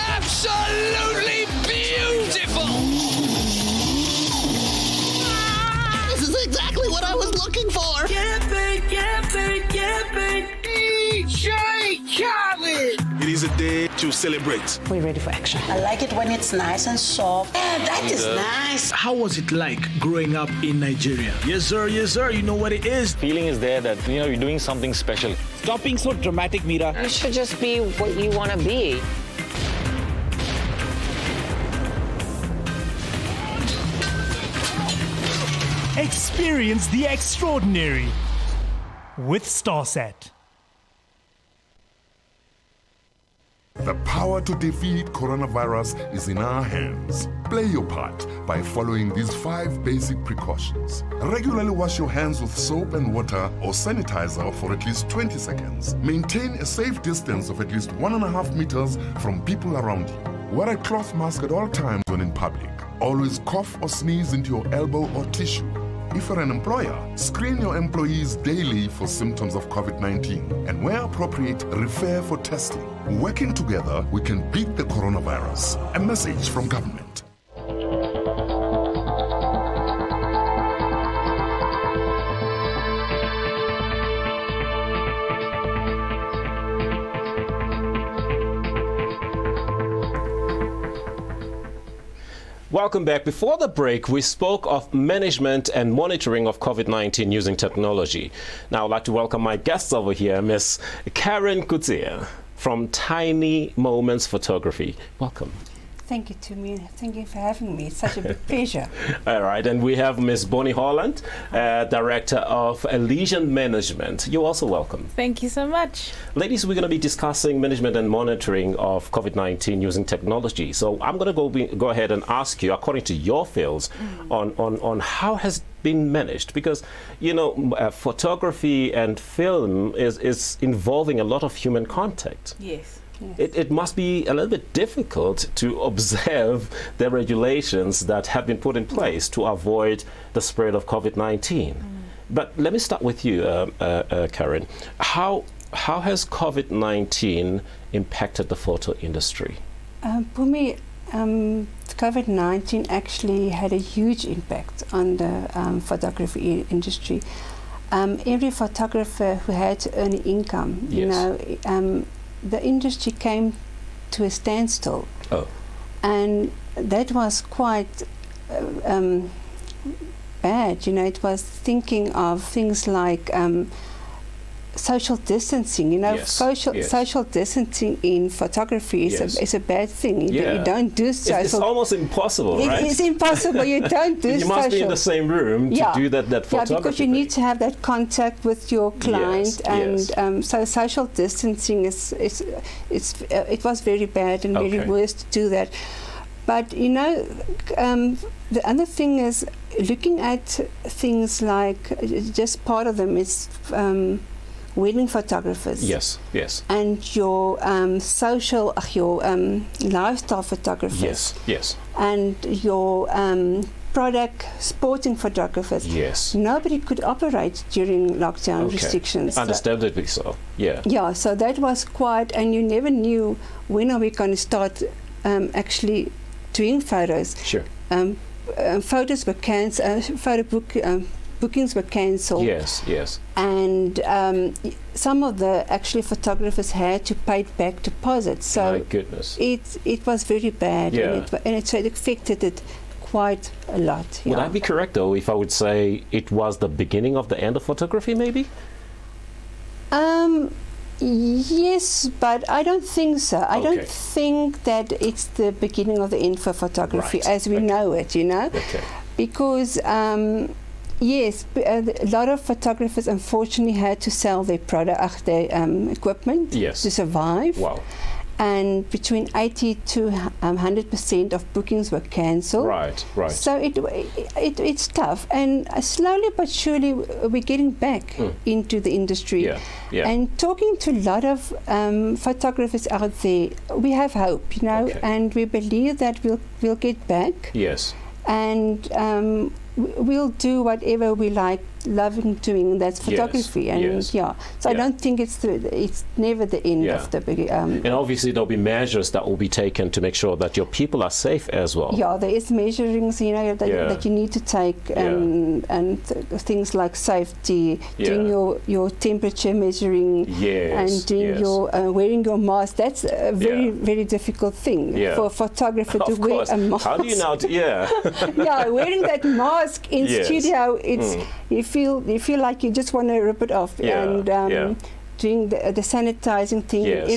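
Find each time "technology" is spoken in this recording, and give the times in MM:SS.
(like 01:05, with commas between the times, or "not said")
01:37, 02:00.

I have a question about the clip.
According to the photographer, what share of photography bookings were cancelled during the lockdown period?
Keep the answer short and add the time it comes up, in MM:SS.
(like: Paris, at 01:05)
80 to 100%, at 04:29.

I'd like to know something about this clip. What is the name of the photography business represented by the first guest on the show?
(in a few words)
Tiny Moments Photography.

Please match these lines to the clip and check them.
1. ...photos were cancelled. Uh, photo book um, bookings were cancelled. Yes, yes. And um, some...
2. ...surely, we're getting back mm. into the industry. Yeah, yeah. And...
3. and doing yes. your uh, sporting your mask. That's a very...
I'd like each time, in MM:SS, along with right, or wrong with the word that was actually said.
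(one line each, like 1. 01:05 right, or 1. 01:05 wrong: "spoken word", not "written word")
1. 03:48 right
2. 04:36 right
3. 05:10 wrong: "wearing", not "sporting".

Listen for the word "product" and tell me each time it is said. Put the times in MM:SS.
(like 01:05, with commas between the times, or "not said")
03:33, 04:24.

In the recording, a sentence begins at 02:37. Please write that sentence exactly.
Um, every photographer who had to earn income, yes.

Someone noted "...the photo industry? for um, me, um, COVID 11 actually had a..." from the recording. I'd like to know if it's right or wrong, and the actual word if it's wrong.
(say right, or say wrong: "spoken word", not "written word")
wrong: "19", not "11".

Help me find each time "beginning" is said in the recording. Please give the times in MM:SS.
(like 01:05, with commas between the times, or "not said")
04:06, 04:15.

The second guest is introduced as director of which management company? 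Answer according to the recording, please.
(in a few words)
Elysian Management.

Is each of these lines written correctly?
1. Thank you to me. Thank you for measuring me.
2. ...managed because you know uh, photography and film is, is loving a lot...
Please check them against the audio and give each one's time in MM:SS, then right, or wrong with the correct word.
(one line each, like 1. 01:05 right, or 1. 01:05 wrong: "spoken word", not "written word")
1. 01:46 wrong: "having", not "measuring"
2. 02:06 wrong: "involving", not "loving".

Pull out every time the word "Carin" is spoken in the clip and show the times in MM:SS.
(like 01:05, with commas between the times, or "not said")
01:41, 02:24.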